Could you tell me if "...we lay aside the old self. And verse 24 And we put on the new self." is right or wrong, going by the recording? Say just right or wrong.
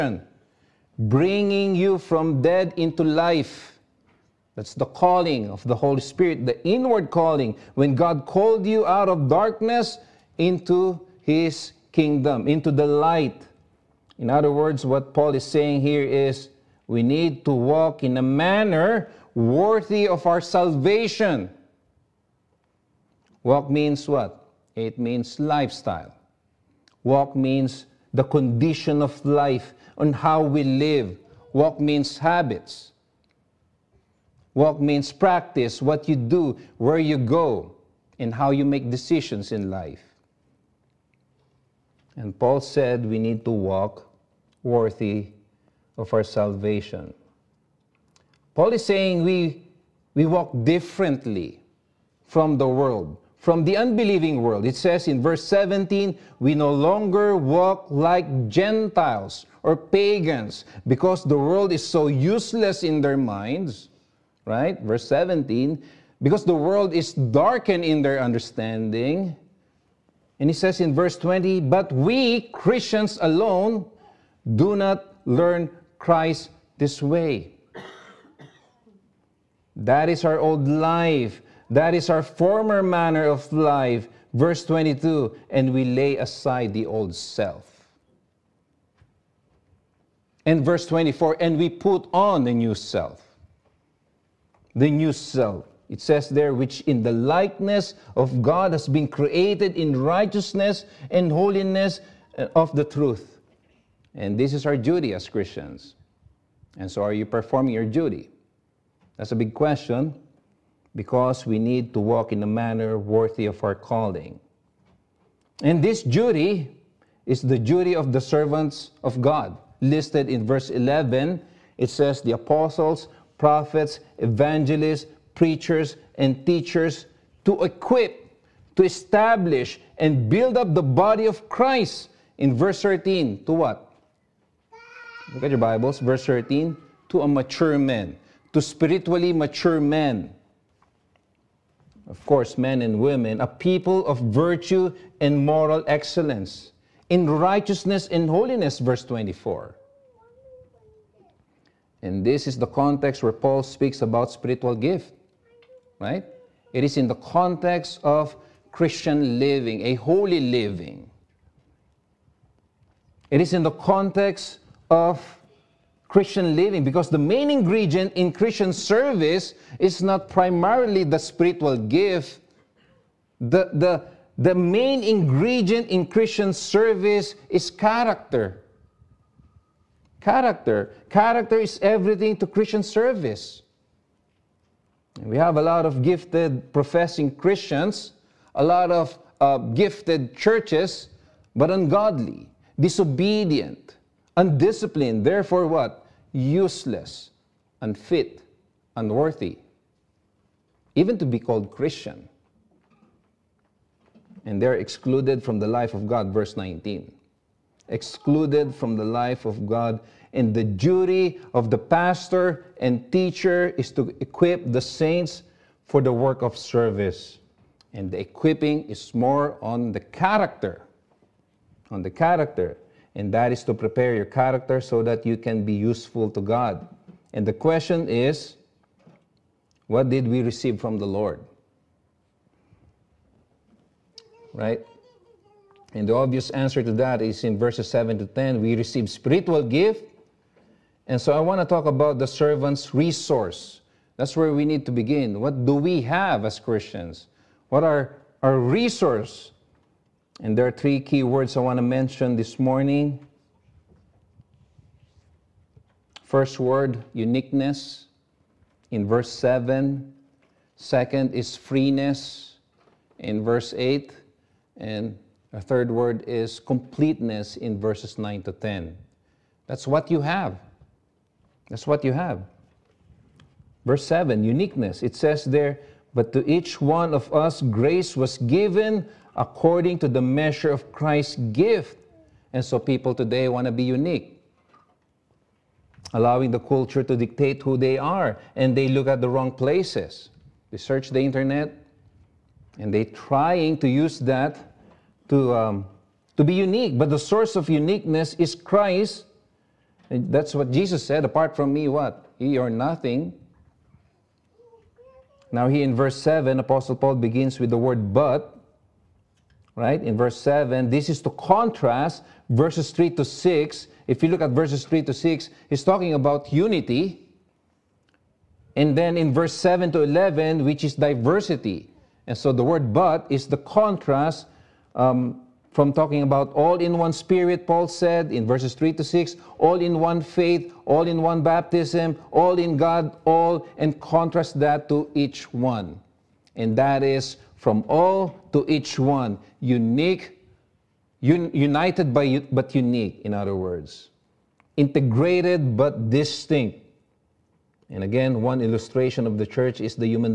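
right.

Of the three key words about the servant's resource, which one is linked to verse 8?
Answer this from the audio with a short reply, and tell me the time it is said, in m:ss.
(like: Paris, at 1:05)
Freeness, at 4:21.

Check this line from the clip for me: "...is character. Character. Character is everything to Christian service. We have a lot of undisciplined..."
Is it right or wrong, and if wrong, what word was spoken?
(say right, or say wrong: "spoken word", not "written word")
wrong: "gifted", not "undisciplined".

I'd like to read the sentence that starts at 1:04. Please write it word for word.
Verse 17, because the world is darkened in their understanding.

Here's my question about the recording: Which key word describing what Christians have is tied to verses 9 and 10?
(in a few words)
Completeness.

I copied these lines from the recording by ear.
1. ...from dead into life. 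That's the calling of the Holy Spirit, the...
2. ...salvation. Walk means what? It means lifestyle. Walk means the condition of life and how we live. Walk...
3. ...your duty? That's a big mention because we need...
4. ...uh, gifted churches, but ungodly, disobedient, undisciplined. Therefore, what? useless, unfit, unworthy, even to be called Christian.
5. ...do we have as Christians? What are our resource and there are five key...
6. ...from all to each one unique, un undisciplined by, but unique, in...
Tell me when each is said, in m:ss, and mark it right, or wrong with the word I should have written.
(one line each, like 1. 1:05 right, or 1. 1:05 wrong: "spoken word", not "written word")
1. 0:01 right
2. 0:20 right
3. 1:47 wrong: "question", not "mention"
4. 3:09 right
5. 4:05 wrong: "three", not "five"
6. 5:37 wrong: "united", not "undisciplined".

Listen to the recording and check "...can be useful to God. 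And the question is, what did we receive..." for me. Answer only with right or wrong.
right.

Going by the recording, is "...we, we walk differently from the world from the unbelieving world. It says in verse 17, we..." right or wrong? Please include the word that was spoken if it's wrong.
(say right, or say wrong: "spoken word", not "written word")
right.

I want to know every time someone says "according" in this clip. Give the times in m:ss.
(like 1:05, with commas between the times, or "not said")
4:39.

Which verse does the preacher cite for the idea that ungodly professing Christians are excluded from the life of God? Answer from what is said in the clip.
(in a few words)
19.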